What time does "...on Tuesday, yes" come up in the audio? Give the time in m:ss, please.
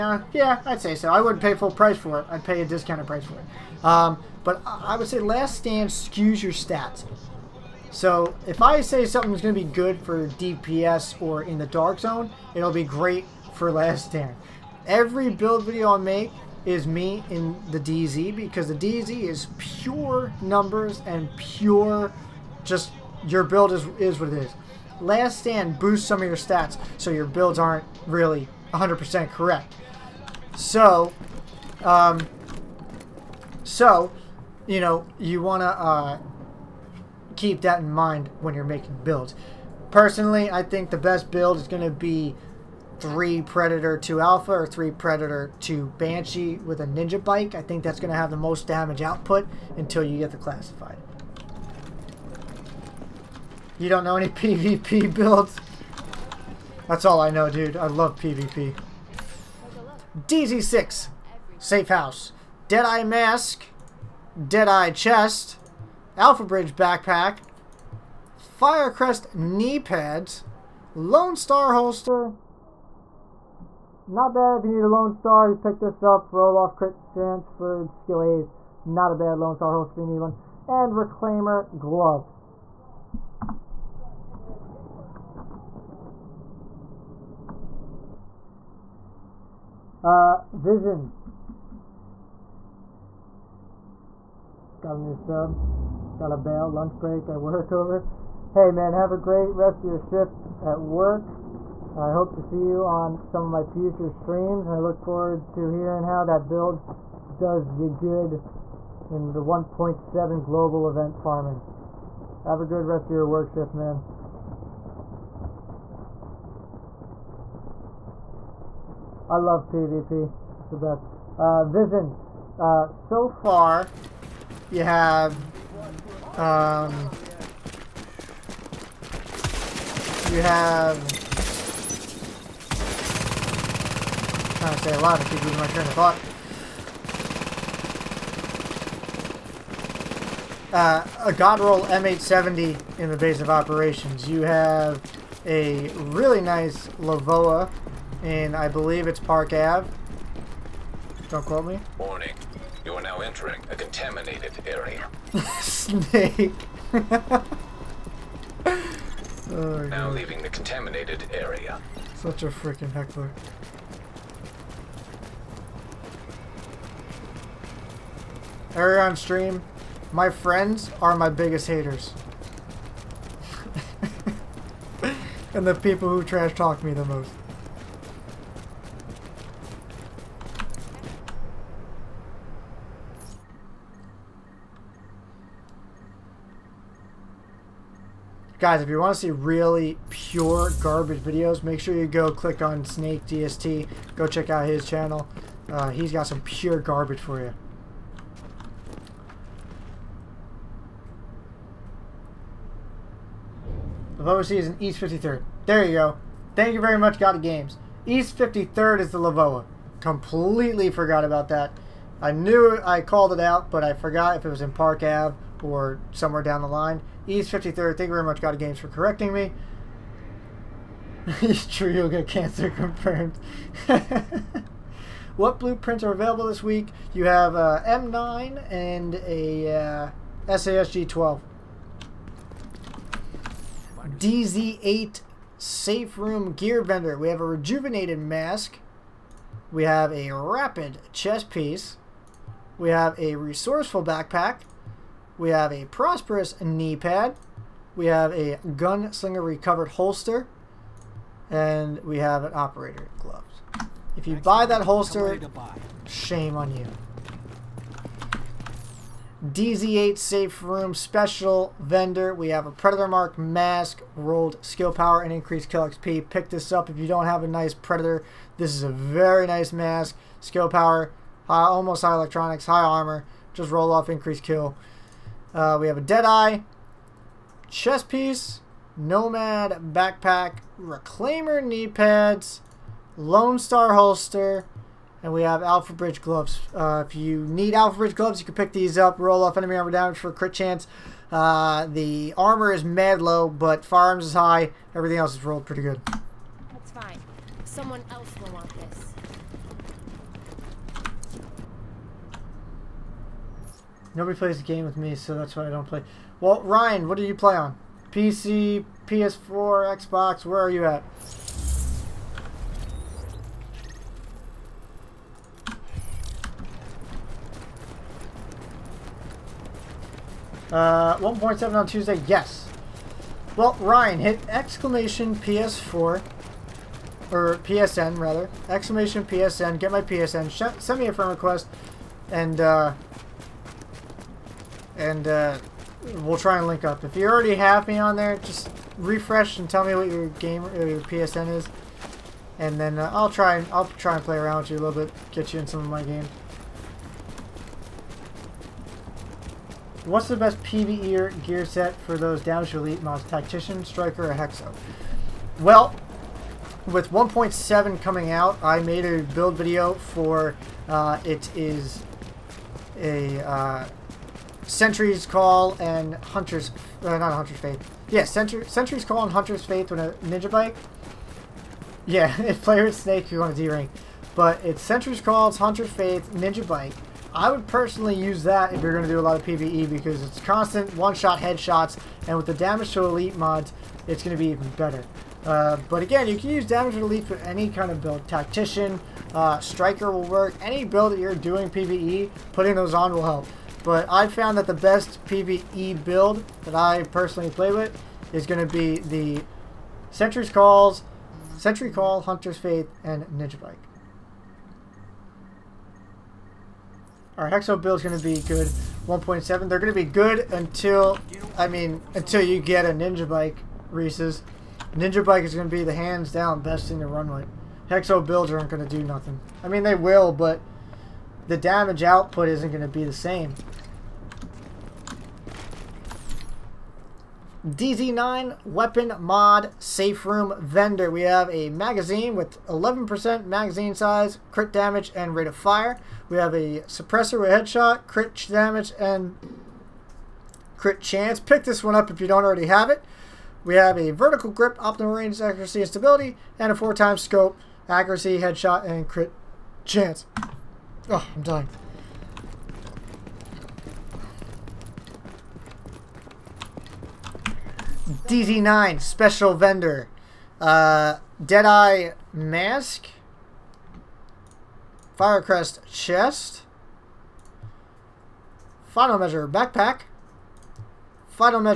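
5:21.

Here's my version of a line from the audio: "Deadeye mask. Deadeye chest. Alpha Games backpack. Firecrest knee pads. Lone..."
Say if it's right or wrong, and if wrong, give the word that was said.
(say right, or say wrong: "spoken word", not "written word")
wrong: "Bridge", not "Games".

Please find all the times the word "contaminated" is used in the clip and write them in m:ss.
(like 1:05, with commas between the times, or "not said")
2:33, 2:40.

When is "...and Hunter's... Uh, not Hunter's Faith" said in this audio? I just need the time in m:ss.
6:05.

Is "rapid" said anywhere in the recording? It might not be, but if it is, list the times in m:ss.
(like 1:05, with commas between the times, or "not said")
4:00.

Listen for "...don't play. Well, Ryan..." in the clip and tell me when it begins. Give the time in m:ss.
5:05.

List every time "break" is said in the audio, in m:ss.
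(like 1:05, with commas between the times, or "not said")
1:36.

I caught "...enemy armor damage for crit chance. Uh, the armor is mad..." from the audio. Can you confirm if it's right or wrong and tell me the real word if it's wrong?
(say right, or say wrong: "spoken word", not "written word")
right.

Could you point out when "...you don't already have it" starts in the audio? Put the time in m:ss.
7:22.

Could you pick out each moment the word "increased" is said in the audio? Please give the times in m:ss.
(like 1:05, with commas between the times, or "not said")
4:25, 4:34.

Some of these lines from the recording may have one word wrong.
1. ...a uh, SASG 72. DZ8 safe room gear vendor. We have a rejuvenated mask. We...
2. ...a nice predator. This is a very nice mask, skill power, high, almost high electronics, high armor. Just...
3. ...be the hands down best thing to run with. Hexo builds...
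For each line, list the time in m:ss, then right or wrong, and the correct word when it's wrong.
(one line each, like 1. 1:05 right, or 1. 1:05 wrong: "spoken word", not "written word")
1. 3:49 wrong: "12", not "72"
2. 4:27 right
3. 6:55 right.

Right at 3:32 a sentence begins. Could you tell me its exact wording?
I knew I called it out, but I forgot if it was in Park Ave or somewhere down the line.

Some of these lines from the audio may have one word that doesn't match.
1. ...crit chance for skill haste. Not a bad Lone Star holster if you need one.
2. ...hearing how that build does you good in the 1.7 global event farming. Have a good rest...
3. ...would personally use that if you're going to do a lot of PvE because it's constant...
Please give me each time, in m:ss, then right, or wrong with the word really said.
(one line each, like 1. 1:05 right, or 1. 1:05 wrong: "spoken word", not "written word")
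1. 1:16 right
2. 1:45 right
3. 6:17 right.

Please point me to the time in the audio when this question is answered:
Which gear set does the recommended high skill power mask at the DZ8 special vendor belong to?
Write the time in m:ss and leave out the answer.
4:22.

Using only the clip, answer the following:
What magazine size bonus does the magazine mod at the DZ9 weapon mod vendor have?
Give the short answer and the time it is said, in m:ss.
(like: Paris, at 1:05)
11%, at 7:12.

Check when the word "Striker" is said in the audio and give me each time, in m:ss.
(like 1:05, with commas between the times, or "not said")
5:53, 6:29.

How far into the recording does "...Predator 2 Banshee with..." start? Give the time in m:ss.
0:44.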